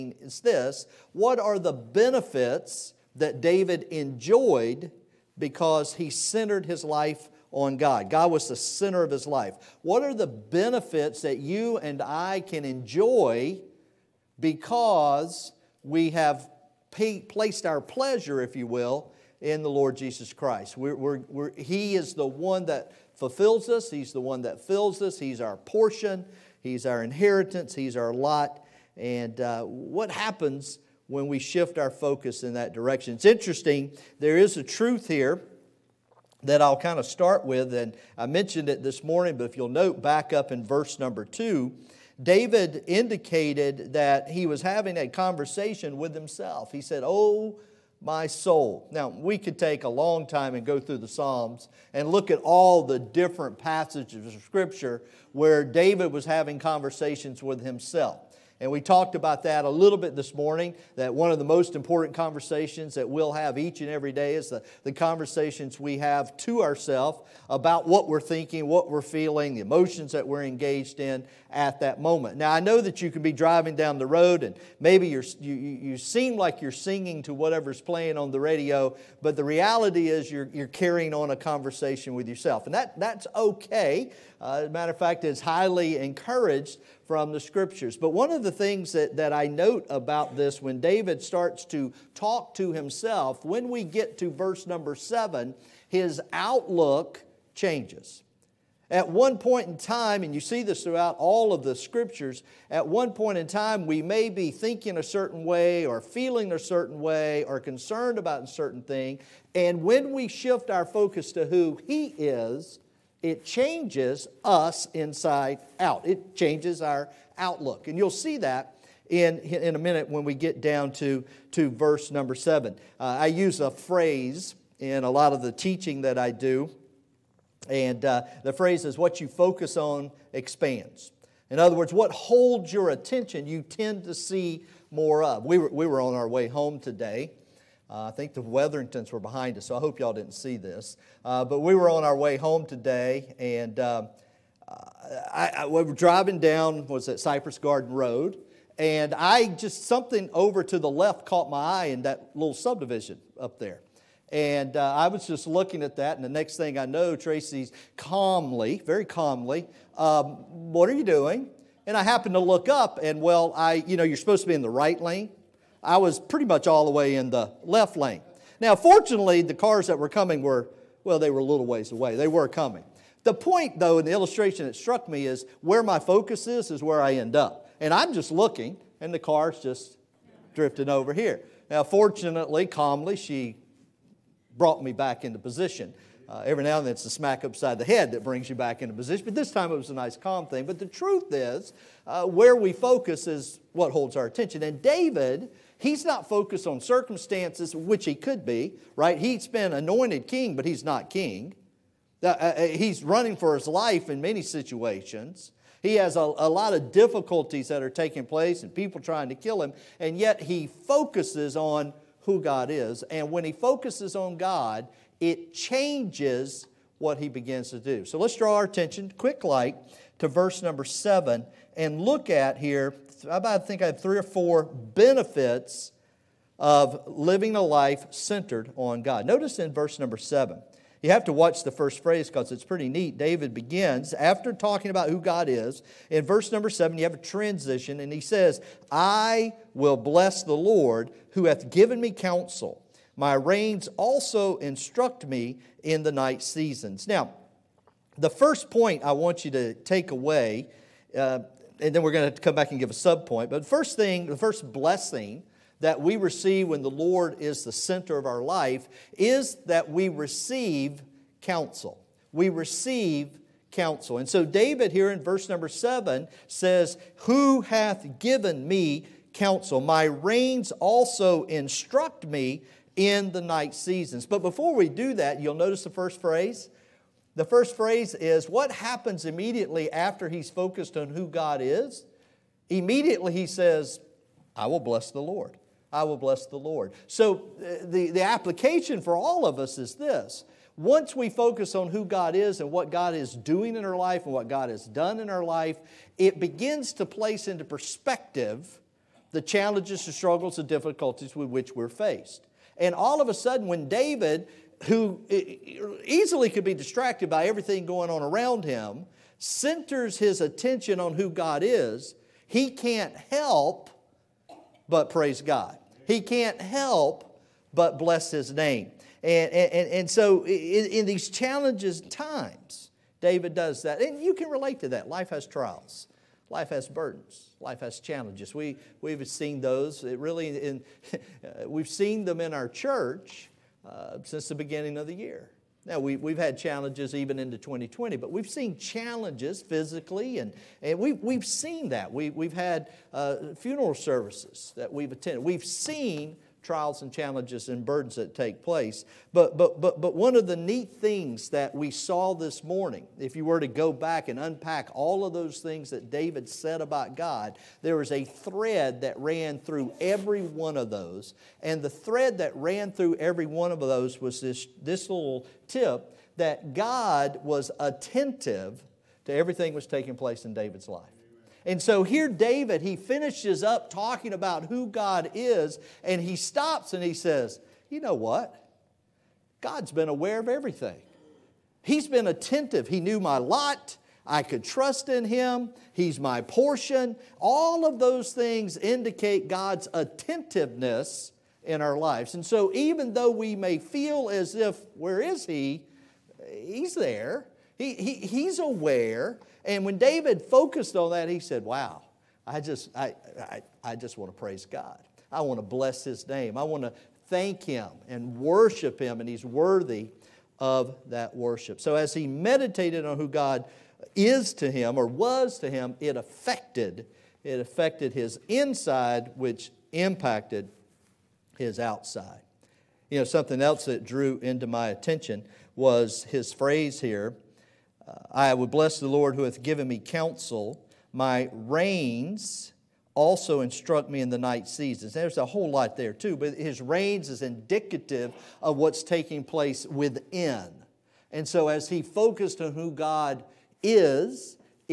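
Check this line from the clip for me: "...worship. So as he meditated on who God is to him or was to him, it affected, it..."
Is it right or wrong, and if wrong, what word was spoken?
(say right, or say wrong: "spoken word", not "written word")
right.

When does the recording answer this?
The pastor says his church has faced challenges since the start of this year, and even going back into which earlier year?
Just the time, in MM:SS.
05:37.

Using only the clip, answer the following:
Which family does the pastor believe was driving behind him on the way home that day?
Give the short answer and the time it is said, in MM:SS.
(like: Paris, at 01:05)
The Weatheringtons, at 02:18.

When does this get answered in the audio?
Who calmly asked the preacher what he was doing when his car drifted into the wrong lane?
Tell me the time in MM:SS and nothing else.
02:37.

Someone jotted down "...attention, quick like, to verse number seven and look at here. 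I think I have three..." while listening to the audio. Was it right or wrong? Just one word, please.
right.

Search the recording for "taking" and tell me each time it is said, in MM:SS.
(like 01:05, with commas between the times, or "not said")
03:27, 06:09, 07:19.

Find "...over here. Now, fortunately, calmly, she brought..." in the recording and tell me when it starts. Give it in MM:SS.
03:00.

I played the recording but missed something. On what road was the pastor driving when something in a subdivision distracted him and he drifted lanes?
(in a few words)
Cypress Garden Road.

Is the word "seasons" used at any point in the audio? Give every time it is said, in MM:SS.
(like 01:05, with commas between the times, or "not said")
04:06, 04:33, 07:14.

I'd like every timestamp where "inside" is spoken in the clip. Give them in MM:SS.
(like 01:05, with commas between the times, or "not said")
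01:54, 06:58.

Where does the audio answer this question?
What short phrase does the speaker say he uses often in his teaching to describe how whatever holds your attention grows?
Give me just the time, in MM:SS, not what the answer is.
02:08.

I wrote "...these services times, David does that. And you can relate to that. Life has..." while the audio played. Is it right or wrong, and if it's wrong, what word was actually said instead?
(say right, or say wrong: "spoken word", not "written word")
wrong: "challenges", not "services".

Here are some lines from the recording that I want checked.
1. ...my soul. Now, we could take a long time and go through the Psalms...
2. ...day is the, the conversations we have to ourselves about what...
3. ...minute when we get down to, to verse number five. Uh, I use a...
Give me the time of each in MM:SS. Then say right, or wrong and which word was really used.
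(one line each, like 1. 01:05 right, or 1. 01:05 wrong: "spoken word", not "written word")
1. 00:47 right
2. 01:04 right
3. 01:59 wrong: "seven", not "five".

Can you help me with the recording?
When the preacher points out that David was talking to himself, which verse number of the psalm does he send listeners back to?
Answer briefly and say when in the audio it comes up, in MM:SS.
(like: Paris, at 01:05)
2, at 00:41.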